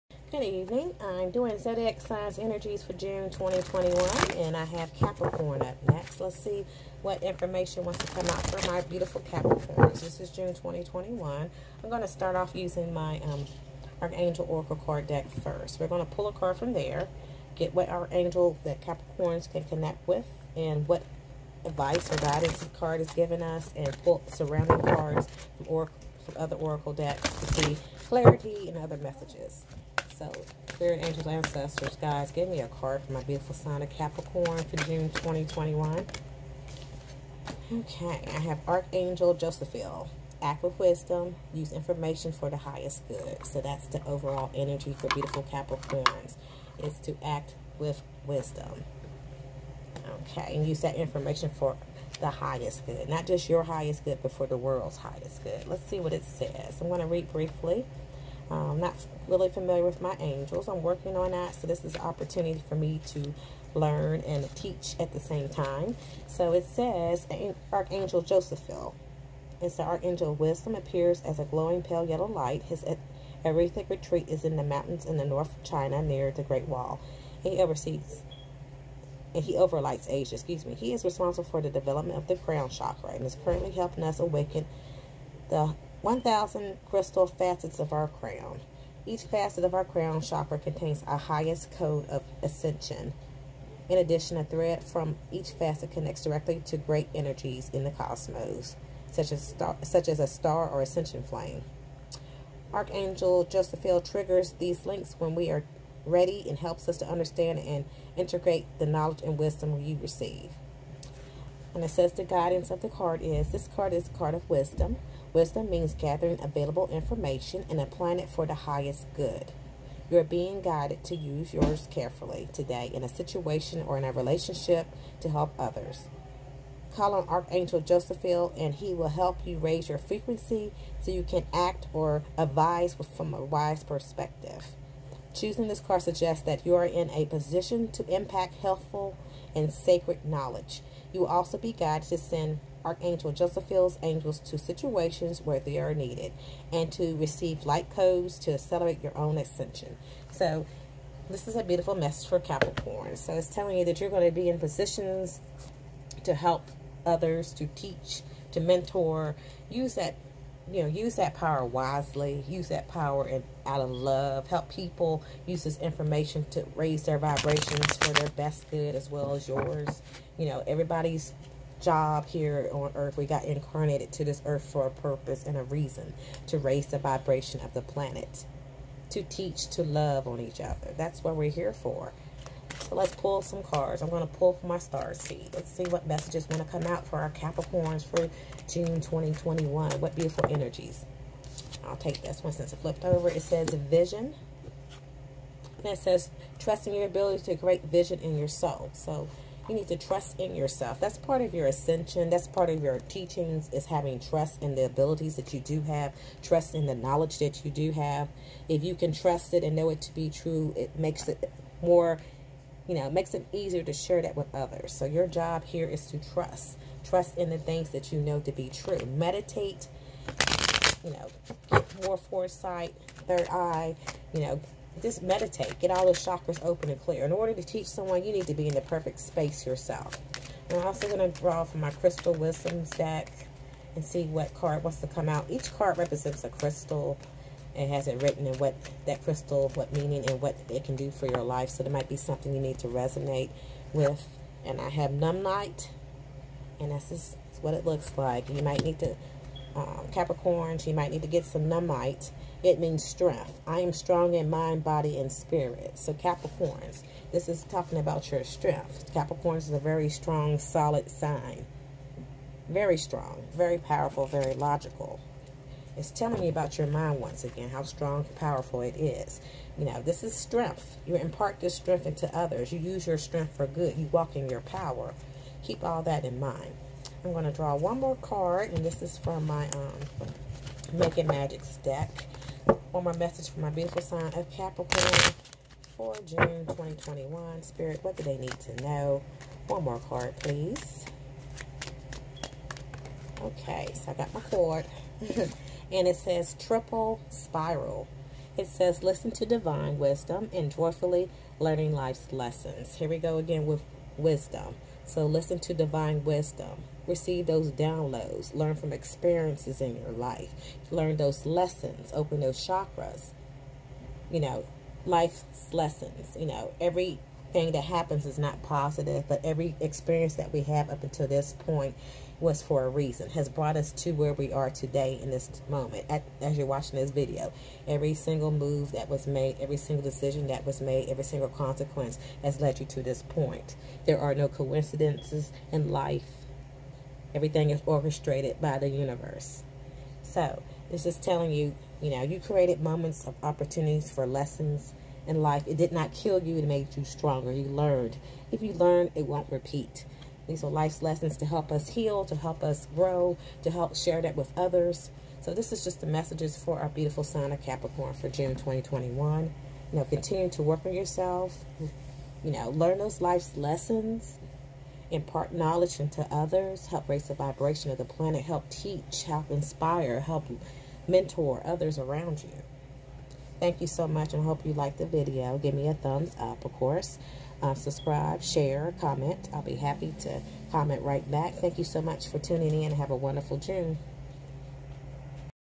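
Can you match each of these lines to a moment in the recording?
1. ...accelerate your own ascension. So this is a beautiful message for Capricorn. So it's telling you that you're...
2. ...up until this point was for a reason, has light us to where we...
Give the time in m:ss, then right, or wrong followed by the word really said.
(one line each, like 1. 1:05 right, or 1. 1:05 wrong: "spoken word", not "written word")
1. 2:28 right
2. 5:20 wrong: "brought", not "light".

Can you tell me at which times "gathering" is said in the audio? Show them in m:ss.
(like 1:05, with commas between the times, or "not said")
1:55.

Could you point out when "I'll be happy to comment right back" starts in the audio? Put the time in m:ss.
6:19.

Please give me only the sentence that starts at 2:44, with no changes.
Help people use this information to raise their vibrations for their best good as well as yours.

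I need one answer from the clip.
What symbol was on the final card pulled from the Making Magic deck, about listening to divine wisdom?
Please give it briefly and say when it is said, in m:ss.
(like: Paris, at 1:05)
triple spiral, at 4:56.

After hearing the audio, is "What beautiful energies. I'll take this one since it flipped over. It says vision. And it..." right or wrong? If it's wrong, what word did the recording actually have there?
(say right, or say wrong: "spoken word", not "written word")
right.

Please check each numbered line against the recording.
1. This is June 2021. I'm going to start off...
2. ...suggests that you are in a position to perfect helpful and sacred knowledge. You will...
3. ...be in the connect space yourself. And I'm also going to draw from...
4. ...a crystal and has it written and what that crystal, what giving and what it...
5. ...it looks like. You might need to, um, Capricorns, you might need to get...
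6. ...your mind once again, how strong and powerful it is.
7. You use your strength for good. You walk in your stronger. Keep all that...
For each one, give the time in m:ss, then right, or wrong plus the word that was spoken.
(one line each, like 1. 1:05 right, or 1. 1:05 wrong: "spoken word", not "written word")
1. 0:09 right
2. 2:16 wrong: "impact", not "perfect"
3. 3:48 wrong: "perfect", not "connect"
4. 3:56 wrong: "meaning", not "giving"
5. 4:07 right
6. 4:26 right
7. 4:32 wrong: "power", not "stronger".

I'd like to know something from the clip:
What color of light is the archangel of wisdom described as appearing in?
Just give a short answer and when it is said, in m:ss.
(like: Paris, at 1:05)
pale yellow, at 1:11.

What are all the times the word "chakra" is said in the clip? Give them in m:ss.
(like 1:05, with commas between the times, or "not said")
1:22, 1:30, 3:46, 5:12.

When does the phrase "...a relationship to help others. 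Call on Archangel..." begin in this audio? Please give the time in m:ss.
2:04.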